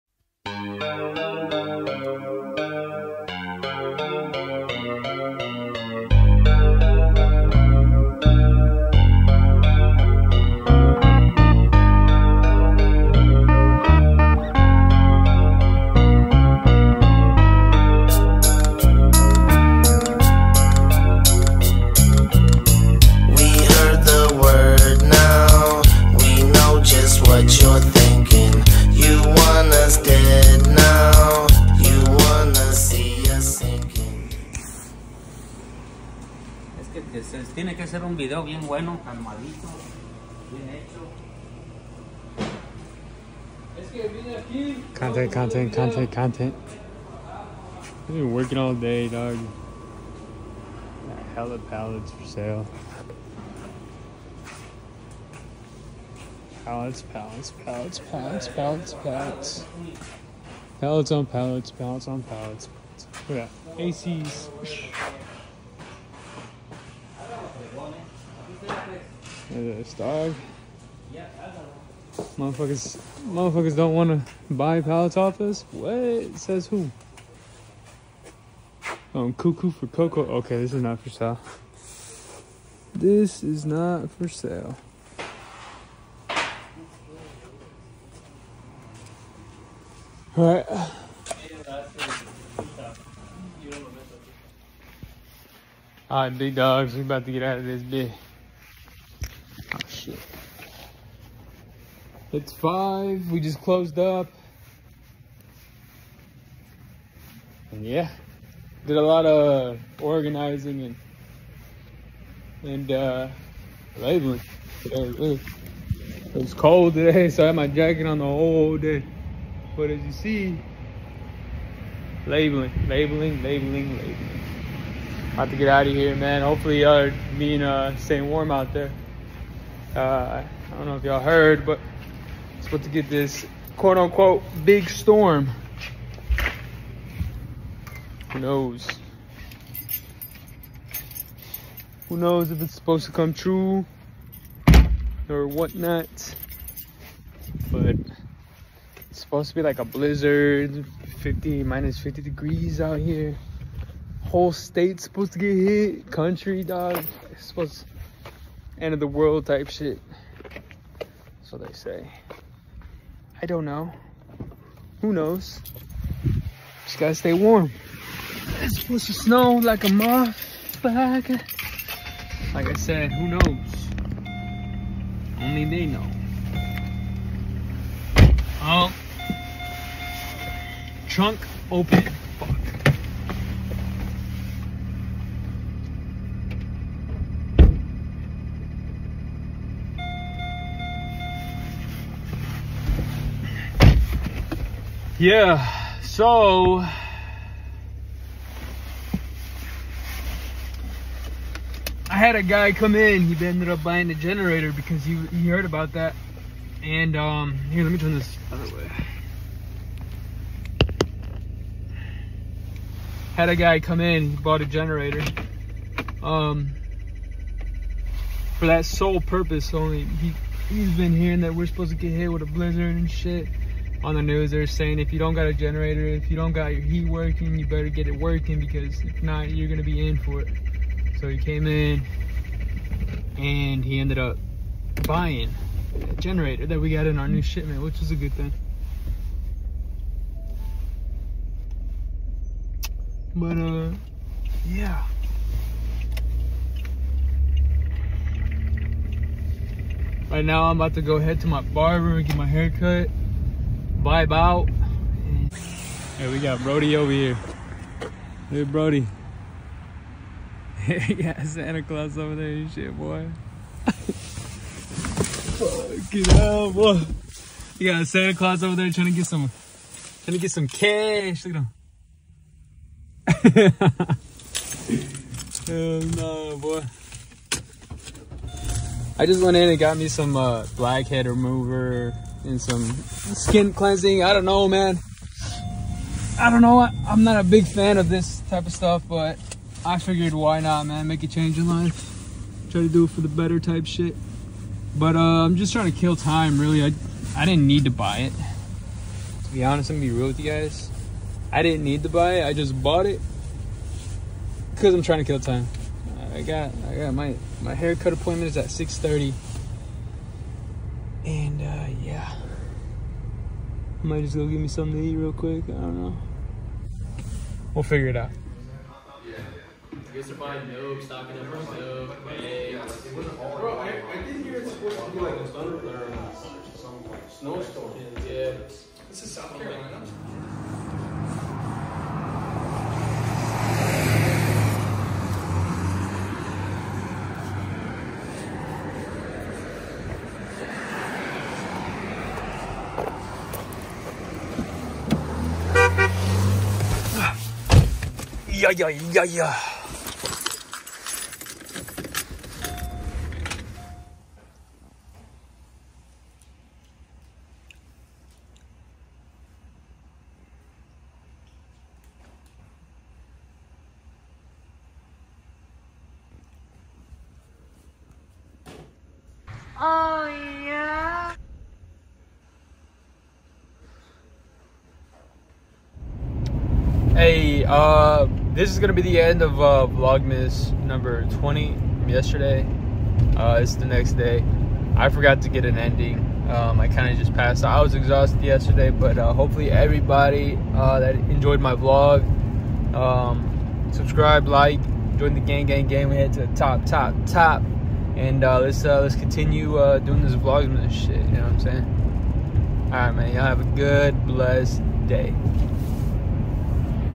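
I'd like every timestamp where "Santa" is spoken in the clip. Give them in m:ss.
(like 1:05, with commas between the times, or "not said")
4:21, 4:28.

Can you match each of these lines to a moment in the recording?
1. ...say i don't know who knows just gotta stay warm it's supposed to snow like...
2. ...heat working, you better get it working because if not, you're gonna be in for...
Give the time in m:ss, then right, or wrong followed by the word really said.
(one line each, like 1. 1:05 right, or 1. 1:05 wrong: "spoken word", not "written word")
1. 2:41 right
2. 3:46 right.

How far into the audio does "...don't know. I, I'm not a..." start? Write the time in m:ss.
4:46.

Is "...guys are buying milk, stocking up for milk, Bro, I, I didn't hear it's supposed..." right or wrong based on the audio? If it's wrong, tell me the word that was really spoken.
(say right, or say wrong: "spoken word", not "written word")
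right.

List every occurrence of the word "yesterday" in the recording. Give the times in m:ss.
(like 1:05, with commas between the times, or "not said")
6:22, 6:28.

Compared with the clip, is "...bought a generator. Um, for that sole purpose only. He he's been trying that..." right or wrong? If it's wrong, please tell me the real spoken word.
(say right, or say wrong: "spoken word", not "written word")
wrong: "hearing", not "trying".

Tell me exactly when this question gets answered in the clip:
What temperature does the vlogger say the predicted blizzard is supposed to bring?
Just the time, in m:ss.
2:31.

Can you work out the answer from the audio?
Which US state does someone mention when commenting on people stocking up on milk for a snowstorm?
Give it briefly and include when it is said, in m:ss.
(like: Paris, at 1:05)
South Carolina, at 5:29.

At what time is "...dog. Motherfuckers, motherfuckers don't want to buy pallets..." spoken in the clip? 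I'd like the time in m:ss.
1:09.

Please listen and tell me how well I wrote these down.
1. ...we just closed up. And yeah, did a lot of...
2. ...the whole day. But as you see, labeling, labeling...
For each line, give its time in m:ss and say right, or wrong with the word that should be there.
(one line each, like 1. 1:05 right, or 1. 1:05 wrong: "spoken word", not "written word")
1. 1:43 right
2. 1:58 right.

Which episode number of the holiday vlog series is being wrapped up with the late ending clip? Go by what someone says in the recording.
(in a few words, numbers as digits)
20.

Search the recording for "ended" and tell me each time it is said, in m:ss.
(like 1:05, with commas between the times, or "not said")
3:23, 3:53.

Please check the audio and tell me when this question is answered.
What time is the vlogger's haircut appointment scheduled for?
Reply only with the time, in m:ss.
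5:08.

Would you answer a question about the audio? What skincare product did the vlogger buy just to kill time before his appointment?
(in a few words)
Blackhead remover.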